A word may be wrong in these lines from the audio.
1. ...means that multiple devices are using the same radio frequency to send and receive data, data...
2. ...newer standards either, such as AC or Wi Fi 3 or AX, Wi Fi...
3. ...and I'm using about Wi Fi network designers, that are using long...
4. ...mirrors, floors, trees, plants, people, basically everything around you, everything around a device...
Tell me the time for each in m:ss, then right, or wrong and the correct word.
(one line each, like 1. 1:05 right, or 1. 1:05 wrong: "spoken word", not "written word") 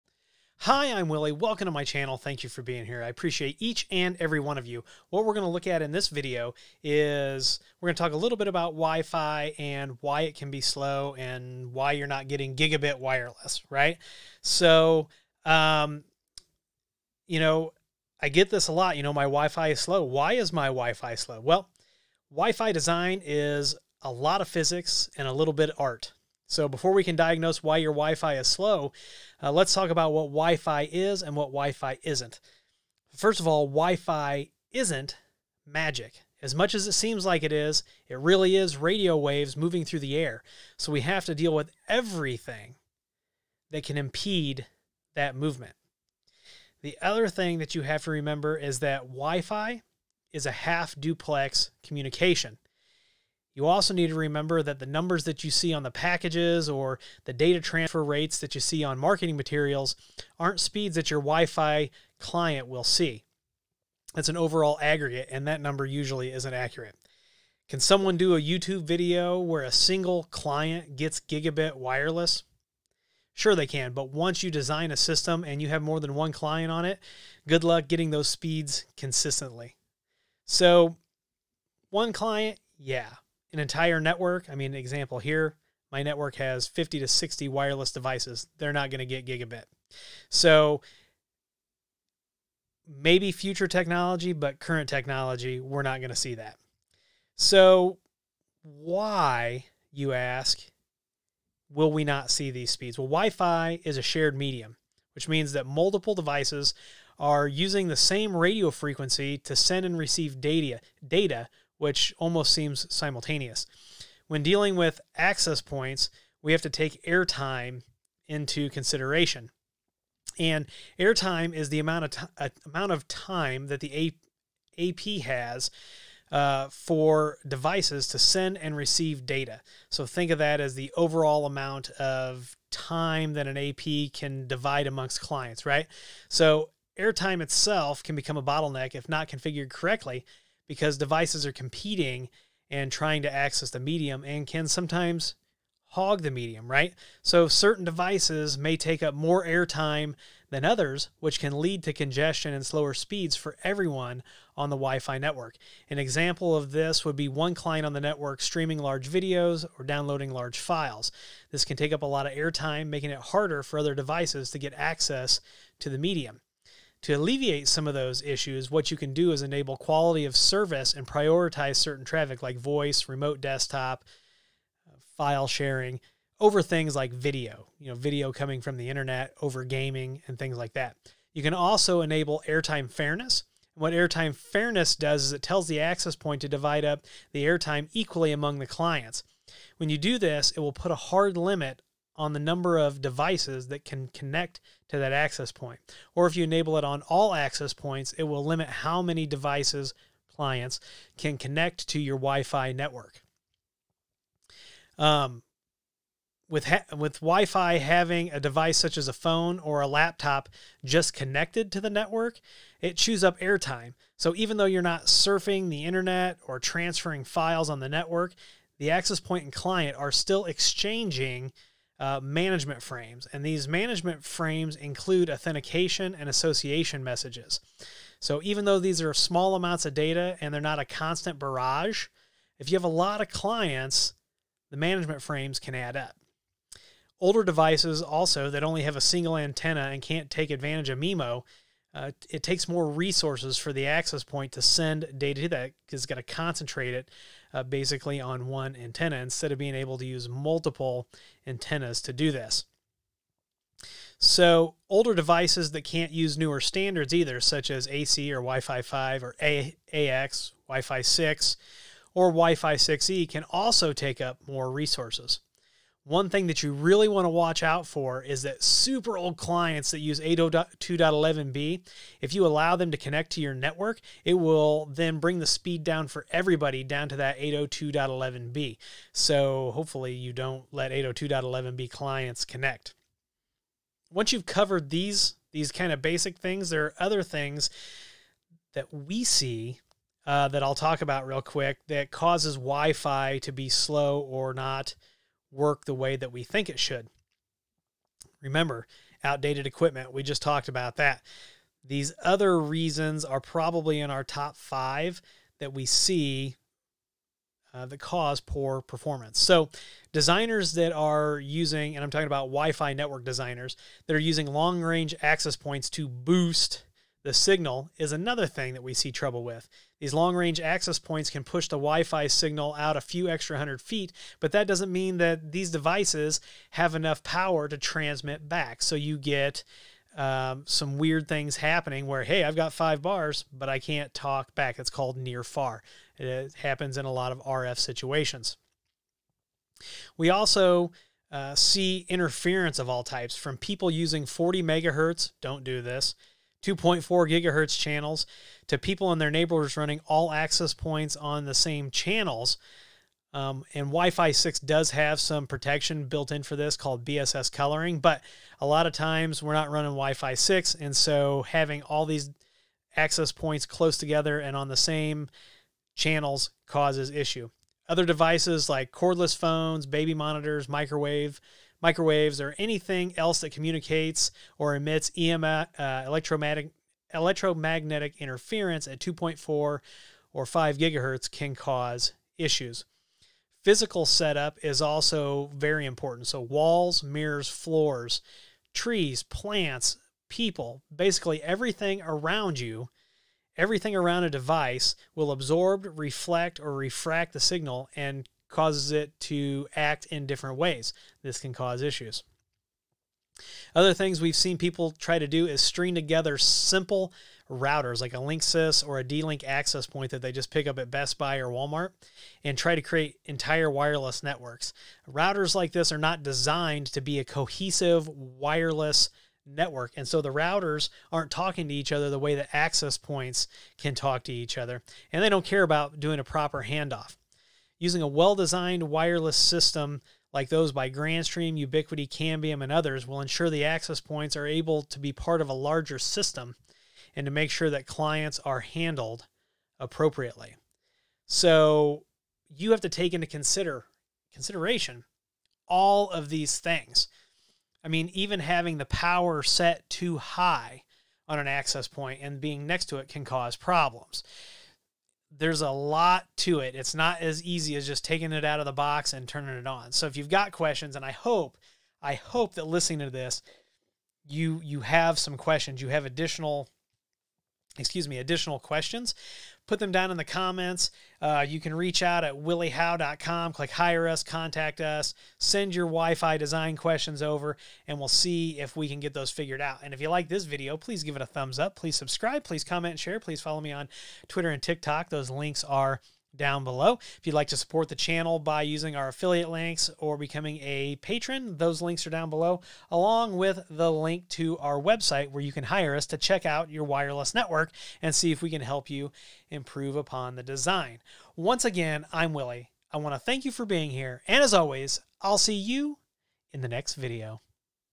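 1. 1:45 right
2. 4:16 wrong: "5", not "3"
3. 5:11 wrong: "talking", not "using"
4. 6:27 right.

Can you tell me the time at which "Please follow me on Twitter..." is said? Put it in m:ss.
8:03.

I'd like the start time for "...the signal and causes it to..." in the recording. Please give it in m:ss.
6:37.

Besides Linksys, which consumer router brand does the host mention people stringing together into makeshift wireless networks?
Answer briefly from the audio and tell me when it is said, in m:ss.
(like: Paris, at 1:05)
D-Link, at 6:49.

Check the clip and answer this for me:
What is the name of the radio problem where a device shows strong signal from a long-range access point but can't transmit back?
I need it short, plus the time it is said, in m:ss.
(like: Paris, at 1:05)
Near far, at 5:35.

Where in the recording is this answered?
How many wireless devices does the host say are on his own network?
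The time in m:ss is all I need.
1:26.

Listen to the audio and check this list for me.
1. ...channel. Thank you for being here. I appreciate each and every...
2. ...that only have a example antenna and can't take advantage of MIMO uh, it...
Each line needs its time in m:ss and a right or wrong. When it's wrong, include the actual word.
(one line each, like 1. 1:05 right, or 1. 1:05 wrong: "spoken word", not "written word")
1. 0:01 right
2. 3:58 wrong: "single", not "example".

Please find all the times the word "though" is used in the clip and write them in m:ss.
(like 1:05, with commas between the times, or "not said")
3:34, 3:48.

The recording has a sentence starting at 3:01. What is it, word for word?
You can also enable airtime fairness.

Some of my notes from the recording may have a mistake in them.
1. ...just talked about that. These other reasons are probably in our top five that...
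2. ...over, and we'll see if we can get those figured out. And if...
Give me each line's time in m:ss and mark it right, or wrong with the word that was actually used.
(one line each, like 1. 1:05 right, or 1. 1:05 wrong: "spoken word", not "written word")
1. 5:00 right
2. 7:57 right.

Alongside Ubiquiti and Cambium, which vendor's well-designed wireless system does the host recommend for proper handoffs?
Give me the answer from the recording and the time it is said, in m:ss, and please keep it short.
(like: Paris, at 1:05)
Grandstream, at 7:10.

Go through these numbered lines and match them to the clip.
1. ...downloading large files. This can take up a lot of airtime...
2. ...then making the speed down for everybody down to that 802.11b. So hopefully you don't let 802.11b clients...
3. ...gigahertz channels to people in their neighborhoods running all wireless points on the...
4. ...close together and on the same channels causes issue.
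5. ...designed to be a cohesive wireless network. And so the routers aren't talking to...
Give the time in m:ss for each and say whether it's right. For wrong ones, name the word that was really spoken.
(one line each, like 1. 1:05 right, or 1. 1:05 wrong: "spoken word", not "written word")
1. 2:39 right
2. 4:34 wrong: "bring", not "making"
3. 5:47 wrong: "access", not "wireless"
4. 6:03 right
5. 6:56 right.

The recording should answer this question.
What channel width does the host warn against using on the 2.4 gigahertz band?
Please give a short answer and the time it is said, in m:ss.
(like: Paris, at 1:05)
40 megahertz, at 5:44.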